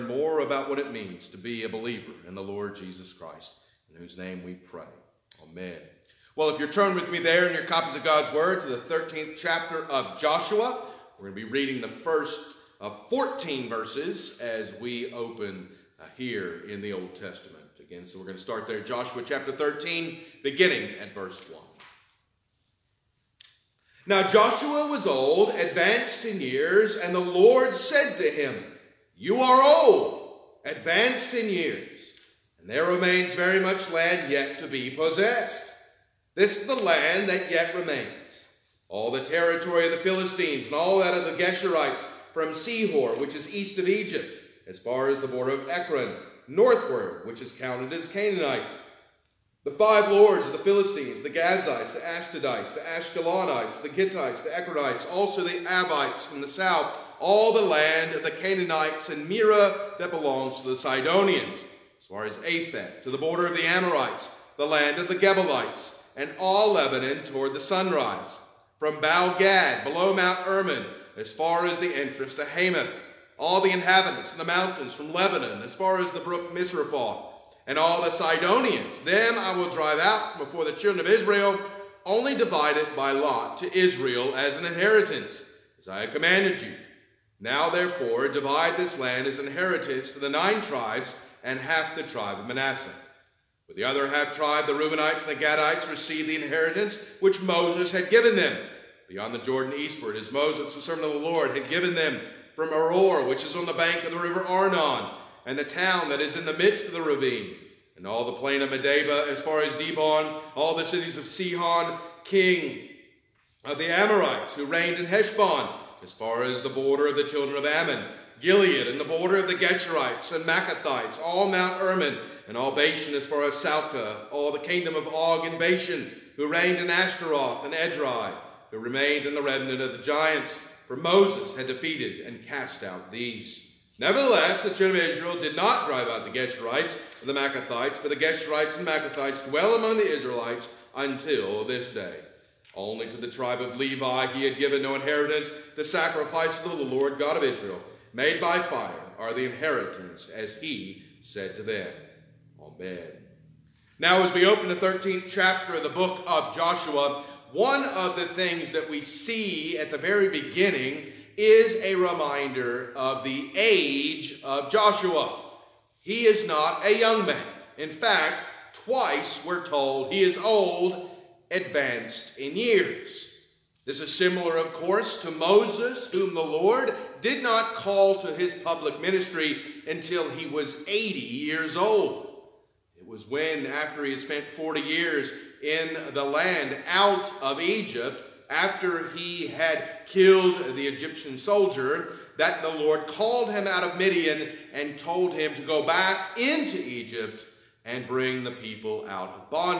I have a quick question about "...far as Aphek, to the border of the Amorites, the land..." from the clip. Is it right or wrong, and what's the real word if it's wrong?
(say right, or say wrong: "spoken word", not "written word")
right.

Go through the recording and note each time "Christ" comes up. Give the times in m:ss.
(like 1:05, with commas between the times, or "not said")
0:03.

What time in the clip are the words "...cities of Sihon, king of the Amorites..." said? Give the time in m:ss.
1:50.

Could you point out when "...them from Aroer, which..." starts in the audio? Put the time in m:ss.
1:41.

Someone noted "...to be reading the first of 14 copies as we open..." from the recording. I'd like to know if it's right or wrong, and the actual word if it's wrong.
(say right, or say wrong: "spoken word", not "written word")
wrong: "verses", not "copies".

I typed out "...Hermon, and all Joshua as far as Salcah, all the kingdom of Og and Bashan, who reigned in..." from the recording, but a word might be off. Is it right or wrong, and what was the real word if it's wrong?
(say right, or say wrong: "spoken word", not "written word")
wrong: "Bashan", not "Joshua".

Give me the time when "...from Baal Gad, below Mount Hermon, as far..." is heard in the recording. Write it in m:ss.
1:08.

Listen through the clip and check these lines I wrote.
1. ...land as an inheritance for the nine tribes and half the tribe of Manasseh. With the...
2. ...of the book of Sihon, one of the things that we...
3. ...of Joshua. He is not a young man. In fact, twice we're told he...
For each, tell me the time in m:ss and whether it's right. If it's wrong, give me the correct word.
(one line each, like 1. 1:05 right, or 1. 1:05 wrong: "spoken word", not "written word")
1. 1:28 right
2. 2:35 wrong: "Joshua", not "Sihon"
3. 2:44 right.